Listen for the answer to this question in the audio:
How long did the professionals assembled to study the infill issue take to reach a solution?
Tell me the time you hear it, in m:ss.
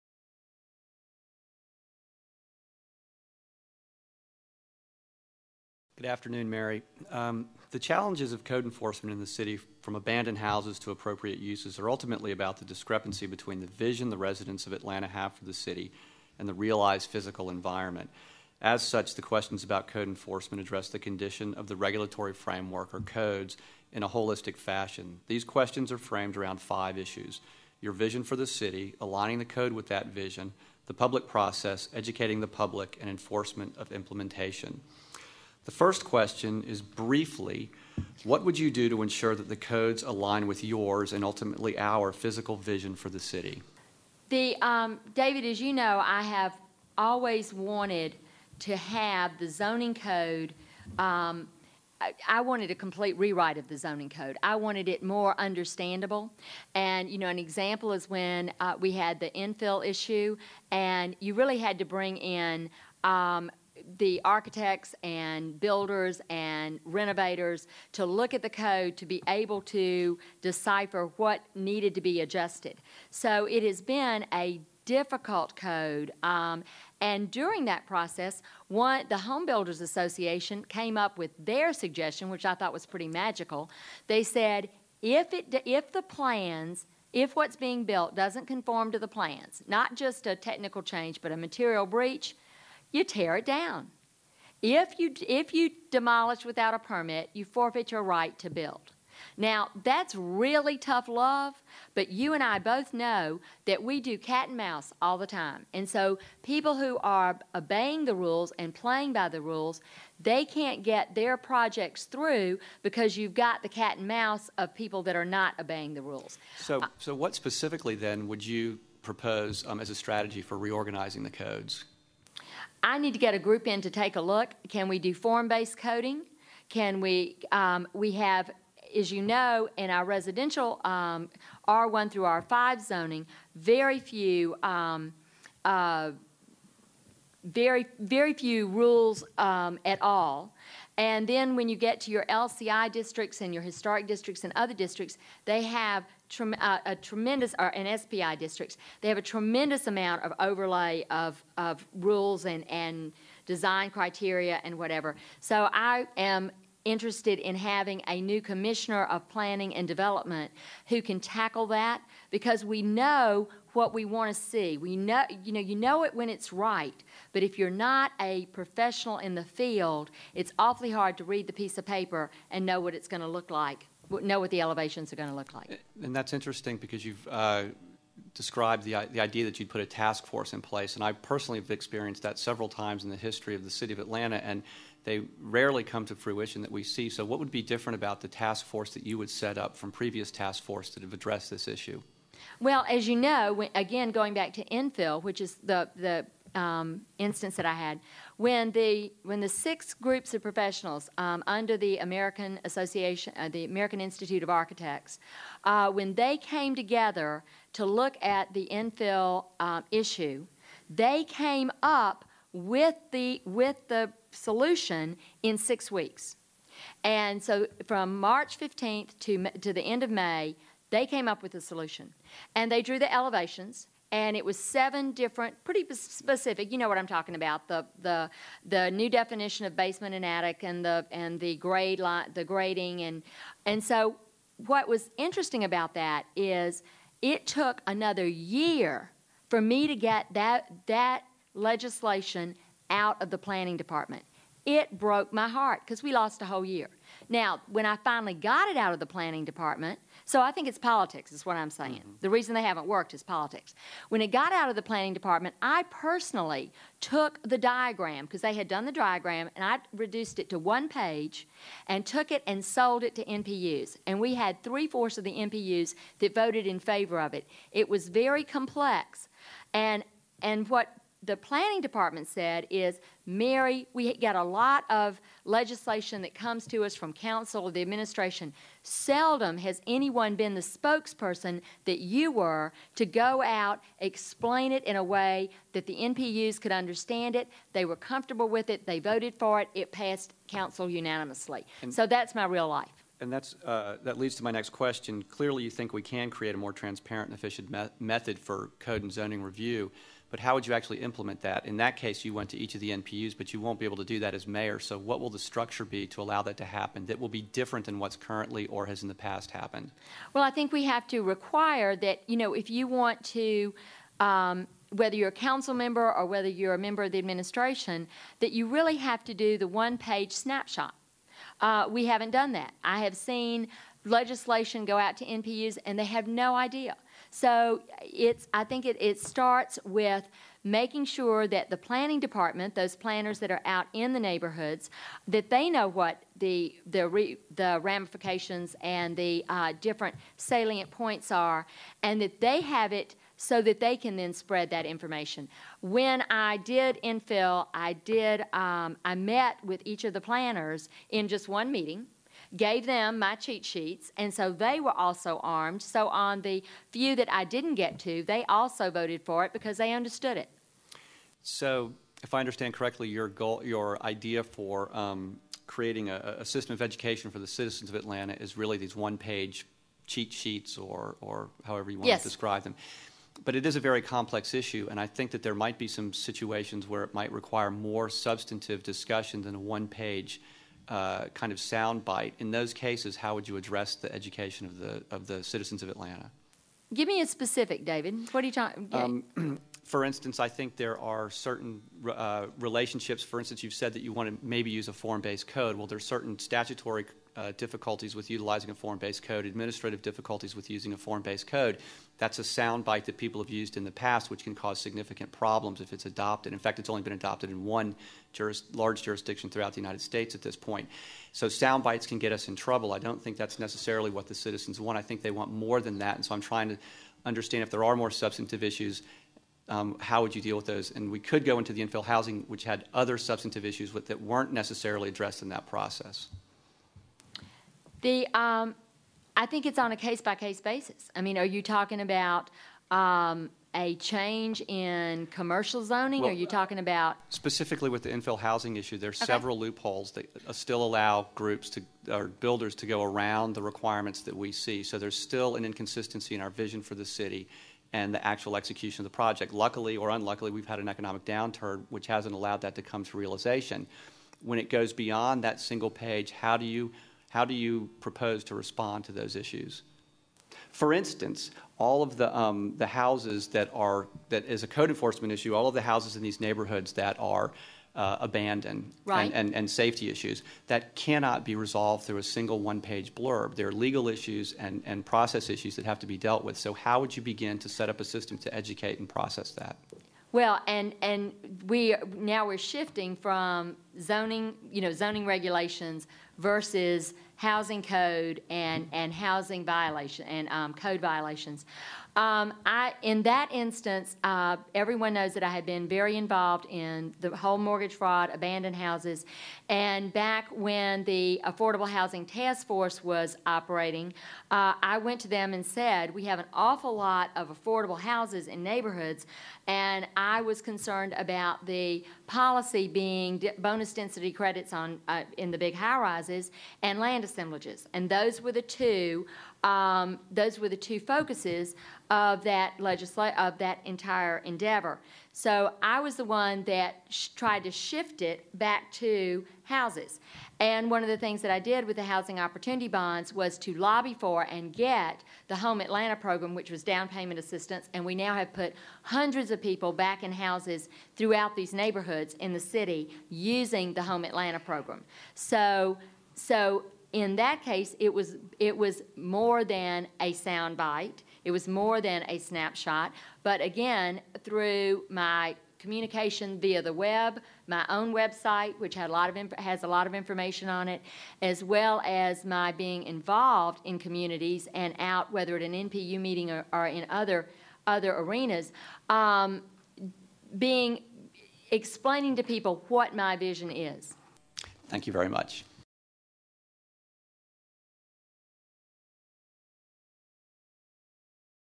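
3:35.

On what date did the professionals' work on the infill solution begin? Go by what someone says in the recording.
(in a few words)
March 15th.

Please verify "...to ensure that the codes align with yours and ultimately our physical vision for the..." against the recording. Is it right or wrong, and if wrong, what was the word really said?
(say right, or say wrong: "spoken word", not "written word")
right.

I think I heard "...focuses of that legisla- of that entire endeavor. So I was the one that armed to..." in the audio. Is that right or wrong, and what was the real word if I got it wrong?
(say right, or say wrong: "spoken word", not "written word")
wrong: "tried", not "armed".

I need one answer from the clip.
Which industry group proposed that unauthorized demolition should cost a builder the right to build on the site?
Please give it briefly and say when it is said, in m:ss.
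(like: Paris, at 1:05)
Home Builders Association, at 1:19.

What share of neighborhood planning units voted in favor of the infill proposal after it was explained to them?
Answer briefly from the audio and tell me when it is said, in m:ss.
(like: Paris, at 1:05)
three fourths, at 4:24.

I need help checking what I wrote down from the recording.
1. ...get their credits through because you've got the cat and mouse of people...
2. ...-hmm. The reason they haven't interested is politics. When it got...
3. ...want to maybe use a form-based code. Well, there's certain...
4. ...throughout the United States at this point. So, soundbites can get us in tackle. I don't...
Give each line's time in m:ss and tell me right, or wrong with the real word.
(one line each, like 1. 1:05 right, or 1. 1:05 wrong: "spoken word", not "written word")
1. 1:50 wrong: "projects", not "credits"
2. 4:12 wrong: "worked", not "interested"
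3. 6:34 right
4. 6:49 wrong: "trouble", not "tackle".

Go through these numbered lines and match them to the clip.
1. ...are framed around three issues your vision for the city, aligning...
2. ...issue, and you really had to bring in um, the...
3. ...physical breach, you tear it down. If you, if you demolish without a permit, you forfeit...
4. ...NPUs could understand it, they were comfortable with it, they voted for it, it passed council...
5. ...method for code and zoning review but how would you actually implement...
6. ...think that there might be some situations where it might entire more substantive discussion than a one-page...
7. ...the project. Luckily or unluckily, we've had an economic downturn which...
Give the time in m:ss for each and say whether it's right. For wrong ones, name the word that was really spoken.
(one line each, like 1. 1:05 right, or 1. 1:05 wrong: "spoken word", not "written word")
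1. 0:25 wrong: "five", not "three"
2. 0:59 right
3. 1:31 wrong: "material", not "physical"
4. 4:45 right
5. 4:57 right
6. 6:15 wrong: "require", not "entire"
7. 7:29 right.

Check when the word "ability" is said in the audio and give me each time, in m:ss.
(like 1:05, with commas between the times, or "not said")
not said.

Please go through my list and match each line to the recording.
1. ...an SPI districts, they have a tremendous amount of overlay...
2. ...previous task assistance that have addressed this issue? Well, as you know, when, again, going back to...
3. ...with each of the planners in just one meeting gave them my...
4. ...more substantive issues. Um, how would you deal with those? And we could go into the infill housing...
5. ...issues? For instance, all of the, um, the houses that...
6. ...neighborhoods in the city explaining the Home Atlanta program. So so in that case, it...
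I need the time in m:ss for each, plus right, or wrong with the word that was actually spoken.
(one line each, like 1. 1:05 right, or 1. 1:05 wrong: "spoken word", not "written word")
1. 2:27 right
2. 3:09 wrong: "force", not "assistance"
3. 5:49 right
4. 6:57 right
5. 7:39 right
6. 9:01 wrong: "using", not "explaining".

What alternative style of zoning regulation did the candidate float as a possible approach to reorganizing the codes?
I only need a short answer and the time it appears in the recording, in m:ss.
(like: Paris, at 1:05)
form-based coding, at 2:05.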